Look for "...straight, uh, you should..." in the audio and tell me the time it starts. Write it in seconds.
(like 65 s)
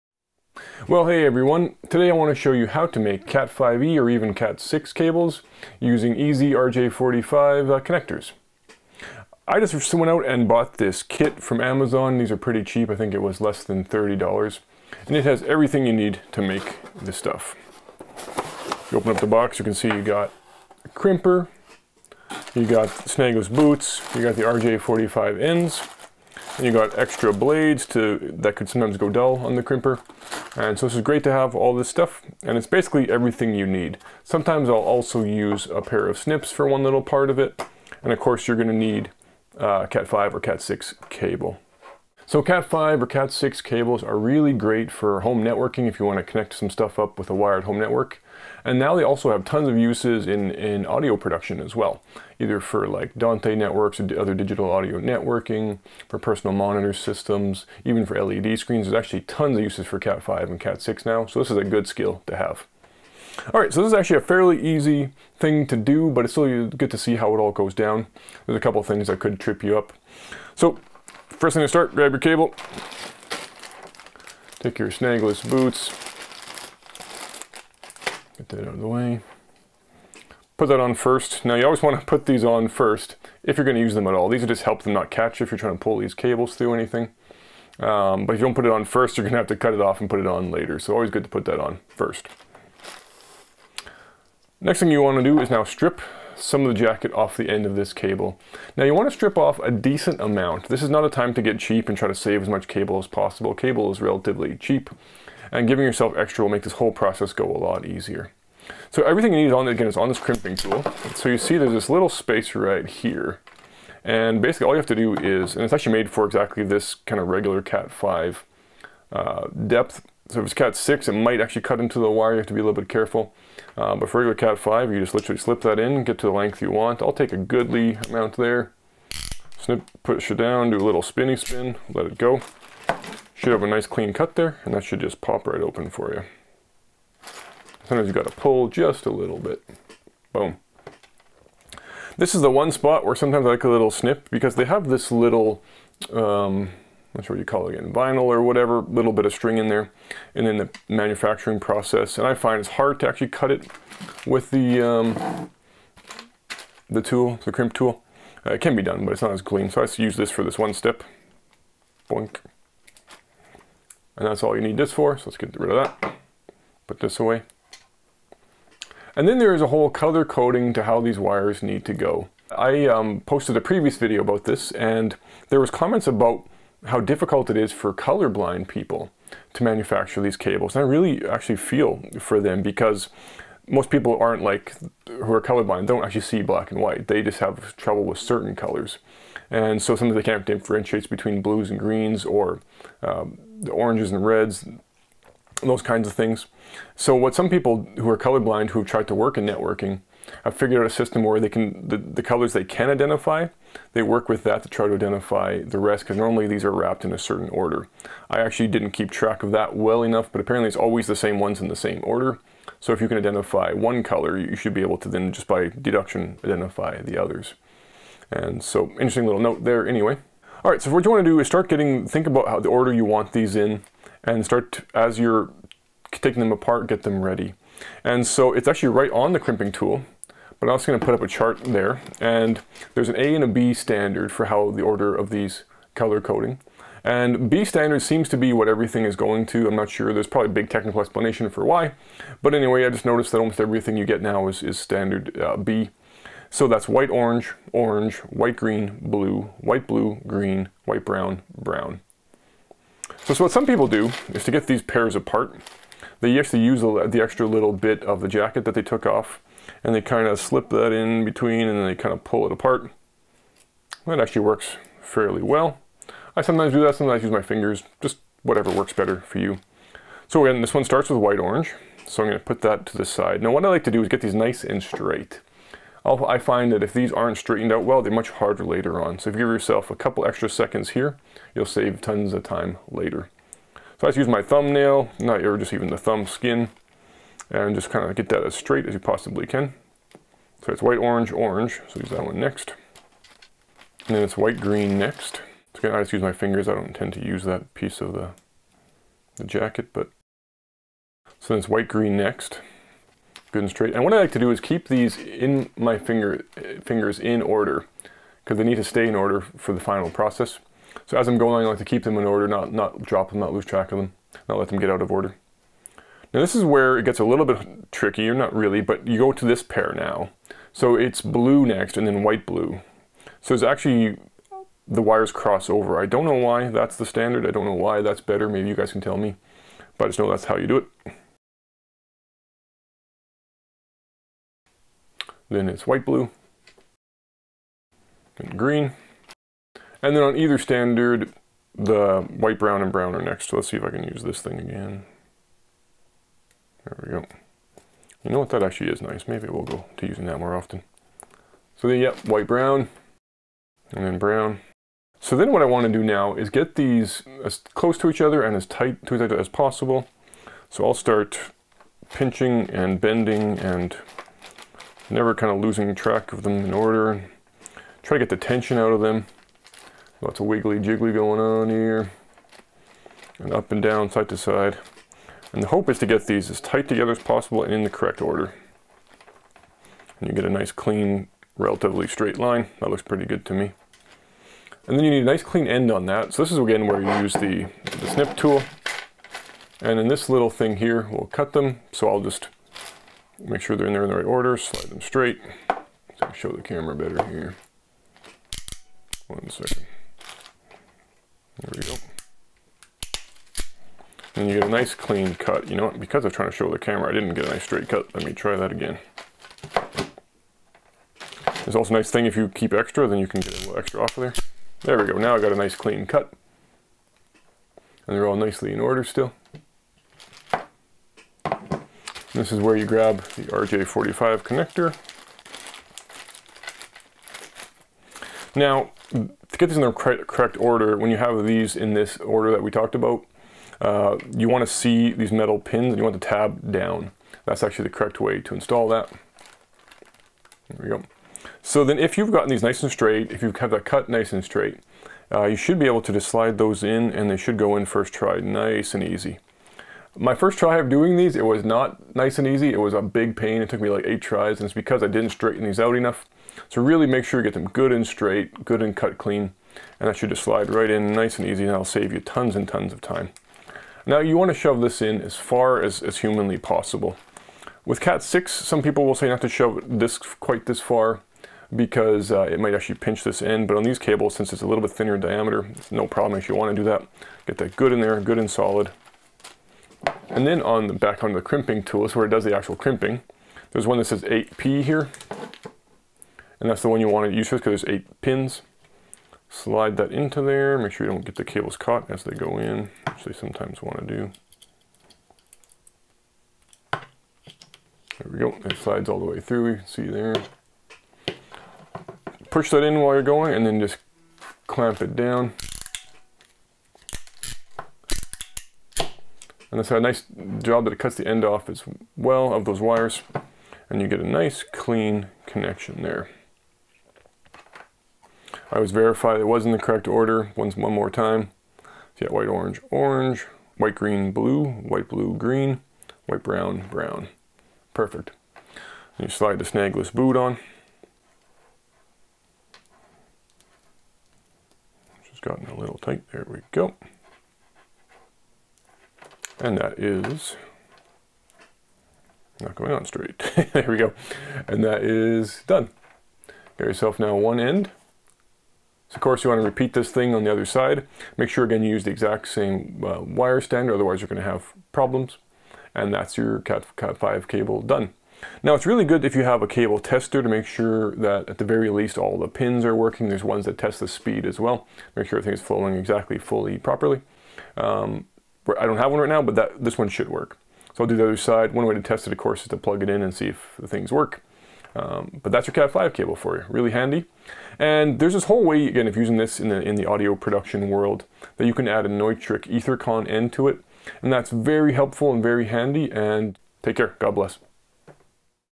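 444 s.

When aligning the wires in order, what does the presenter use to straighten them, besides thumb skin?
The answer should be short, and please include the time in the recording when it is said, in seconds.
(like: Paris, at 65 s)
thumbnail, at 284 s.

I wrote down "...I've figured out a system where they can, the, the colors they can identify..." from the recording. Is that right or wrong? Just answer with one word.
right.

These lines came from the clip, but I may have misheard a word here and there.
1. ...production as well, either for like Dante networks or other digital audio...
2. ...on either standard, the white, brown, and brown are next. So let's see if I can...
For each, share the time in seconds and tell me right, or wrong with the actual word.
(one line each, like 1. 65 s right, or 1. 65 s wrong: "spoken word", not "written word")
1. 51 s right
2. 340 s right.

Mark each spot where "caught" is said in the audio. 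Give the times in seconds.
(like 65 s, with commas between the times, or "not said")
491 s.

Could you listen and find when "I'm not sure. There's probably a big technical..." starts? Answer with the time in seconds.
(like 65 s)
239 s.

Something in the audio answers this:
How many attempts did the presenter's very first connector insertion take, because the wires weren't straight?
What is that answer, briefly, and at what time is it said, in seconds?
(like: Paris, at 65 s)
8, at 454 s.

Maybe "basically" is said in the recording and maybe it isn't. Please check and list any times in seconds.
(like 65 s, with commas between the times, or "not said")
32 s, 114 s.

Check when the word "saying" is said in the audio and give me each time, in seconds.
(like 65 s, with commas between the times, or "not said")
not said.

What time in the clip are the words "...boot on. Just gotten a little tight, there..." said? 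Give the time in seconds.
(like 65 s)
530 s.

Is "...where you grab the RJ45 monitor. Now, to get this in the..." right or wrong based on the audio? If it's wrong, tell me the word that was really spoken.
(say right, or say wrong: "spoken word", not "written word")
wrong: "connector", not "monitor".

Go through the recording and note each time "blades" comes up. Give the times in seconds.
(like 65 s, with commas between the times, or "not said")
27 s.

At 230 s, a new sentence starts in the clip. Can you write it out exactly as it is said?
But I'm also going to put up a chart there.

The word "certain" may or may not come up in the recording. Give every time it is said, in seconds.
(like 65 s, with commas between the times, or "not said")
188 s, 207 s.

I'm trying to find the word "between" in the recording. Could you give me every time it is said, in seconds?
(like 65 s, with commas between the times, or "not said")
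191 s, 261 s.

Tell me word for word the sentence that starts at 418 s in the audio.
And they're all nicely in order still.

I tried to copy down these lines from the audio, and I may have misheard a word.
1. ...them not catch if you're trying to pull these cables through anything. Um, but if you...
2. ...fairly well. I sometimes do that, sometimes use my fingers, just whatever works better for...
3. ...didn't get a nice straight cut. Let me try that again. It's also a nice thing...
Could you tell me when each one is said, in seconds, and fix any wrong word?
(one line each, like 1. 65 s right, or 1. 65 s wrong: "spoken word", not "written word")
1. 84 s right
2. 265 s right
3. 407 s right.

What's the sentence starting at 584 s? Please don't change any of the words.
And that's very helpful and very handy, and take care, God bless.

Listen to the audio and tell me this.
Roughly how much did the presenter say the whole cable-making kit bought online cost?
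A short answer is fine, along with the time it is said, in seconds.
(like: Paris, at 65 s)
less than $30, at 13 s.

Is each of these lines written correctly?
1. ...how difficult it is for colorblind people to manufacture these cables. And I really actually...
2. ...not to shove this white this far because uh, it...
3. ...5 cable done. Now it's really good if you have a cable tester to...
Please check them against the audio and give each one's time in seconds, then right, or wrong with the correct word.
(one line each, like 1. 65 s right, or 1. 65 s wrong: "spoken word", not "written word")
1. 176 s right
2. 469 s wrong: "quite", not "white"
3. 557 s right.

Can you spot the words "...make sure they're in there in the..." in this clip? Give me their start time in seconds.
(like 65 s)
393 s.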